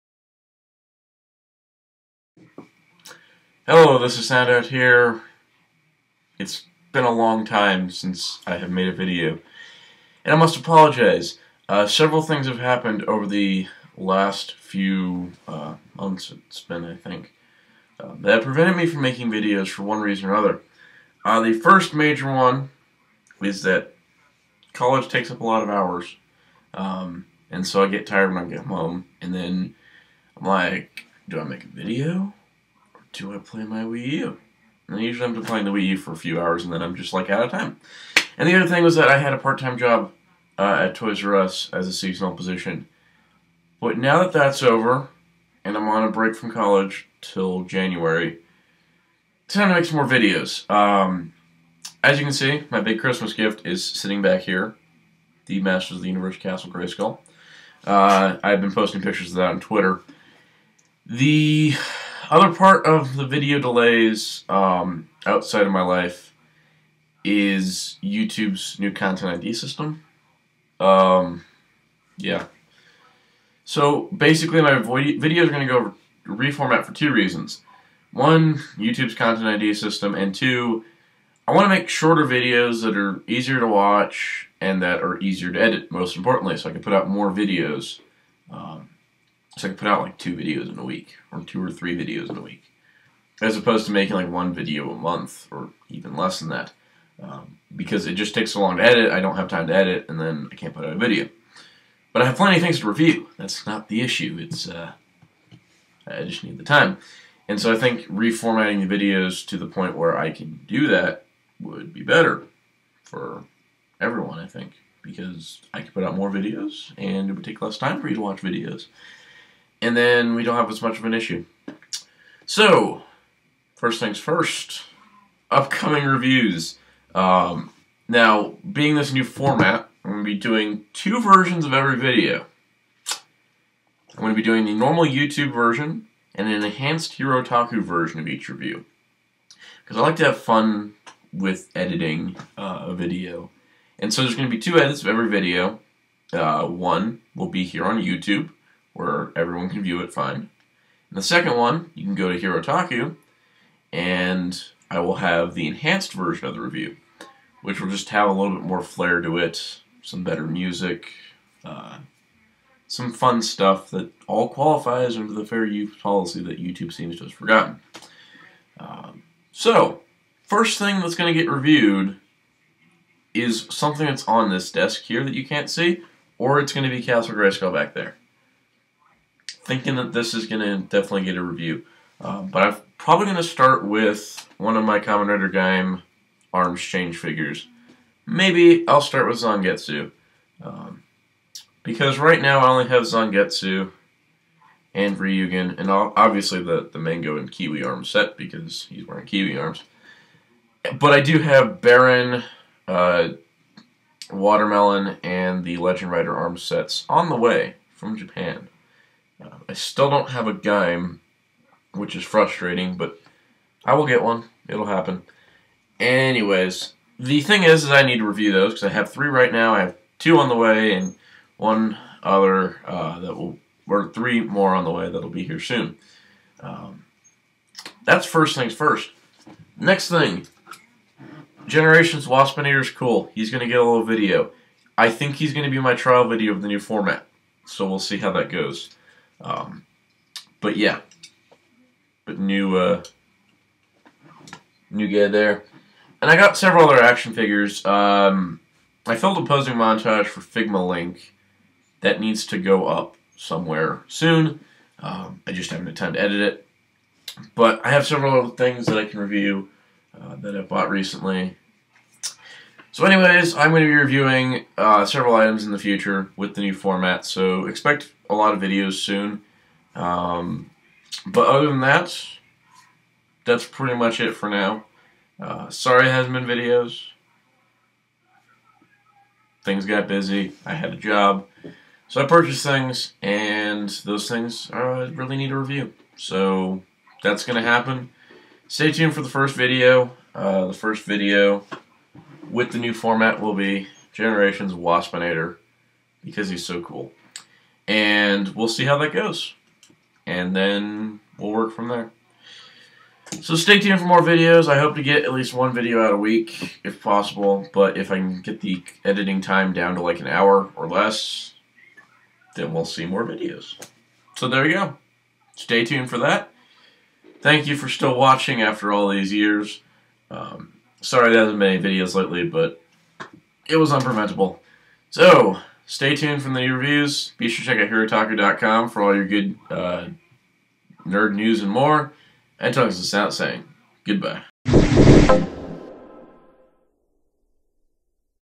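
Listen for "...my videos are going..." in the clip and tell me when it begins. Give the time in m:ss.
1:14.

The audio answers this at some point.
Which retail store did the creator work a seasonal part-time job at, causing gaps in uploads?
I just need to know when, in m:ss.
0:40.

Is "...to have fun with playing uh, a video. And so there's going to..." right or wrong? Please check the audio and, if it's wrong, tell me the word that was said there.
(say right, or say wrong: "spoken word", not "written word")
wrong: "editing", not "playing".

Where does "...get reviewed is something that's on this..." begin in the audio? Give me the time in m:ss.
2:51.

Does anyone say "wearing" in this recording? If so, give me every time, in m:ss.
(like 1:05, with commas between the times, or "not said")
3:19.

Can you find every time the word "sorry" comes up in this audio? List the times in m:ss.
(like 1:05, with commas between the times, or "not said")
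4:35, 5:21.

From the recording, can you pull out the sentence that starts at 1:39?
I don't have time to edit, and then I can't put out a video.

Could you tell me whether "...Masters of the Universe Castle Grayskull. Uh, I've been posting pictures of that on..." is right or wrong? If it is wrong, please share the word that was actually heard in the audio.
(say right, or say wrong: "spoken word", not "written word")
right.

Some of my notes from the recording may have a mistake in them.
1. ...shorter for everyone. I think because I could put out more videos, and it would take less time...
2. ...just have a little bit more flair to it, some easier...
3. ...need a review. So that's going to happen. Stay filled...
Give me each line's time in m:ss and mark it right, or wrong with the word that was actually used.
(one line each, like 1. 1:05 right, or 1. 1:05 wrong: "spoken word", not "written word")
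1. 1:52 wrong: "better", not "shorter"
2. 2:37 wrong: "better", not "easier"
3. 4:45 wrong: "tuned", not "filled".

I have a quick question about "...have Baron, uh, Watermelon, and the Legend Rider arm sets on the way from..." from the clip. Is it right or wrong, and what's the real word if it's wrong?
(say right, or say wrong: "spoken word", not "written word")
right.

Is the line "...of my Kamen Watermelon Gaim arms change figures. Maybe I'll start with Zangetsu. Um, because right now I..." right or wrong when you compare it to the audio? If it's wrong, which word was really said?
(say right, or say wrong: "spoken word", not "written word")
wrong: "Rider", not "Watermelon".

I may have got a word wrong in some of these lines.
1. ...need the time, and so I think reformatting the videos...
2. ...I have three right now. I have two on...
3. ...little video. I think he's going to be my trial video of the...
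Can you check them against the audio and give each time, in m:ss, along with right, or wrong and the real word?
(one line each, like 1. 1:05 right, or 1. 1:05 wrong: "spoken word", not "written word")
1. 1:46 right
2. 3:38 right
3. 3:53 right.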